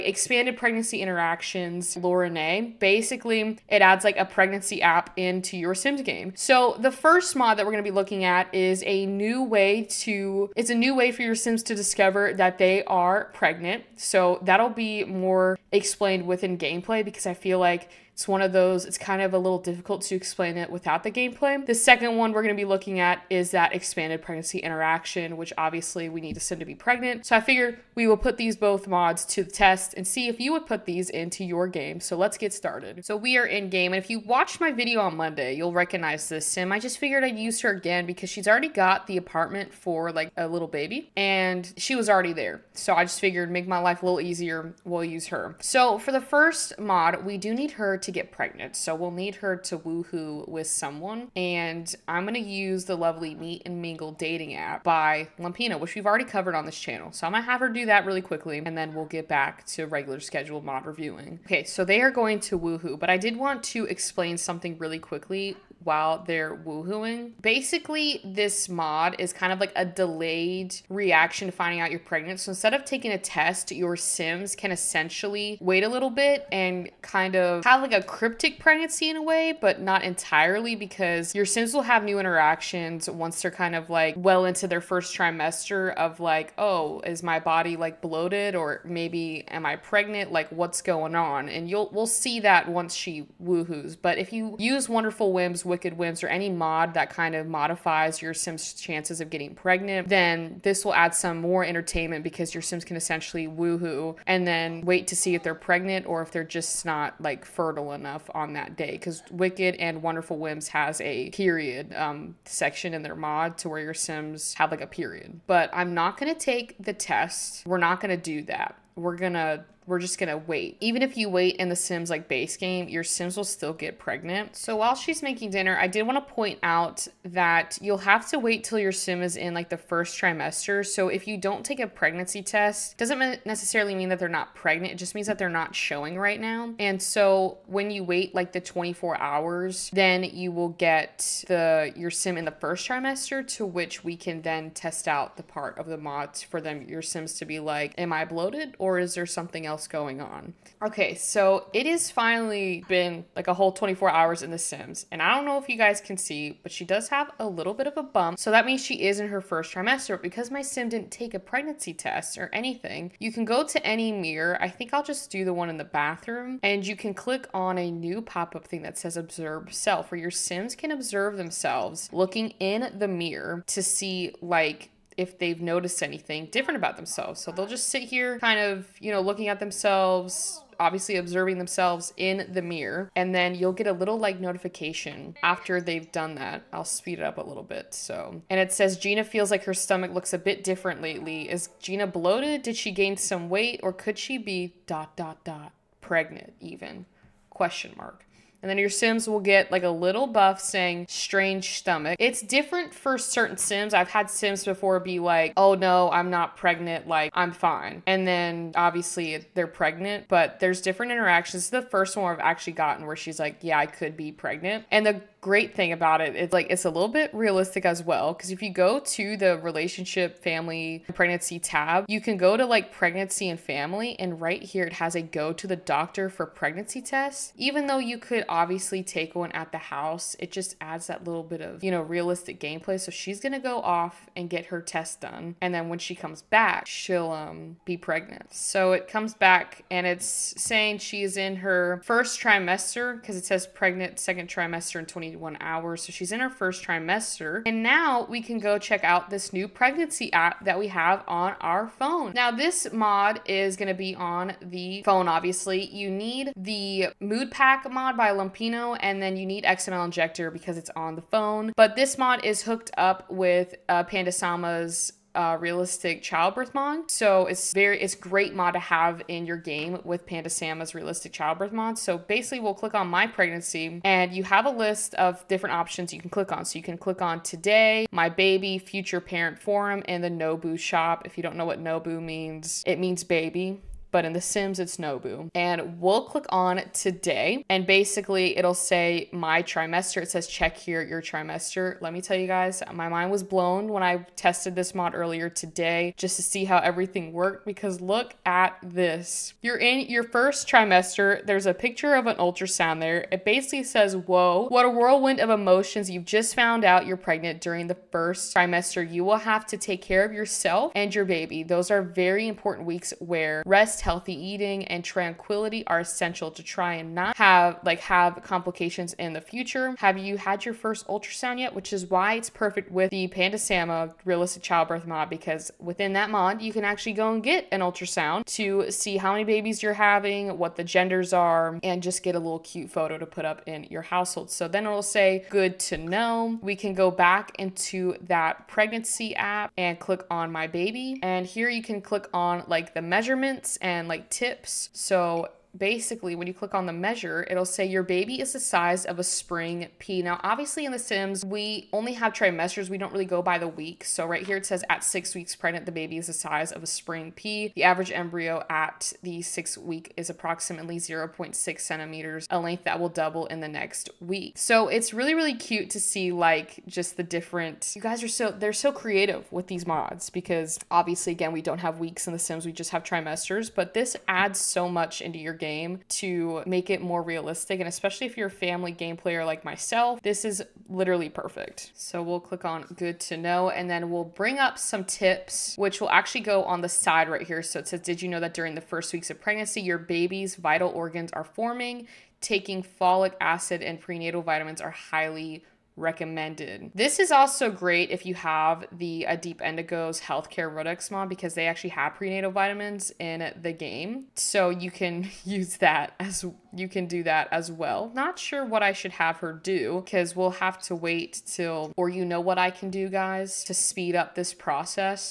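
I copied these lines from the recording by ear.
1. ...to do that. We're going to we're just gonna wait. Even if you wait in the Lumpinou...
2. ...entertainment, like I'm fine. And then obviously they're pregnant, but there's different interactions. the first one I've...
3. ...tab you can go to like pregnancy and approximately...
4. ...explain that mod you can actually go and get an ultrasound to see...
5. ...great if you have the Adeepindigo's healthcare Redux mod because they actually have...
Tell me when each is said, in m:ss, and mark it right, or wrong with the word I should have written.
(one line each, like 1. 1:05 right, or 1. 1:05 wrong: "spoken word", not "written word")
1. 1:58 wrong: "Sims", not "Lumpinou"
2. 3:26 wrong: "pregnant", not "entertainment"
3. 3:41 wrong: "family", not "approximately"
4. 5:25 wrong: "within", not "explain"
5. 6:37 right.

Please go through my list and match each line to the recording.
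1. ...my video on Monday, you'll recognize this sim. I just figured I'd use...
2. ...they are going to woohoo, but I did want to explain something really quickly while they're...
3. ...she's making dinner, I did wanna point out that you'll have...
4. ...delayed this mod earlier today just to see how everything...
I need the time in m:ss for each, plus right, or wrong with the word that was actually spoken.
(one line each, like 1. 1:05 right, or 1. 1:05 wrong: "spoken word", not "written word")
1. 0:34 right
2. 1:01 right
3. 2:04 right
4. 4:54 wrong: "tested", not "delayed".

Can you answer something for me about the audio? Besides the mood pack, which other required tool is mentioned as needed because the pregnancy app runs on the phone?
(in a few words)
XML Injector.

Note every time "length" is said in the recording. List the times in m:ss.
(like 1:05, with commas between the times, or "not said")
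6:02.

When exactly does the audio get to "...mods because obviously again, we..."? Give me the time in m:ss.
6:09.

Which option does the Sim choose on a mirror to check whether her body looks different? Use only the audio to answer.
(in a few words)
Observe self.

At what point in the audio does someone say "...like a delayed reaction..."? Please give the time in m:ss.
1:09.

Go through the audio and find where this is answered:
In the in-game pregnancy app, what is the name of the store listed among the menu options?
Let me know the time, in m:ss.
4:40.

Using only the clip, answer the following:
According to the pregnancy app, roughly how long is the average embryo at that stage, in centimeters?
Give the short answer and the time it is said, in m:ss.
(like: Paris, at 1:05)
0.6 centimeters, at 6:00.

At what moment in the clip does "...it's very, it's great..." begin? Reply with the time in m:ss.
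4:27.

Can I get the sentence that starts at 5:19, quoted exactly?
Have you had your first ultrasound yet?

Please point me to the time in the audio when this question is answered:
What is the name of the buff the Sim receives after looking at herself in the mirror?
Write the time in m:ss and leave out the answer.
3:21.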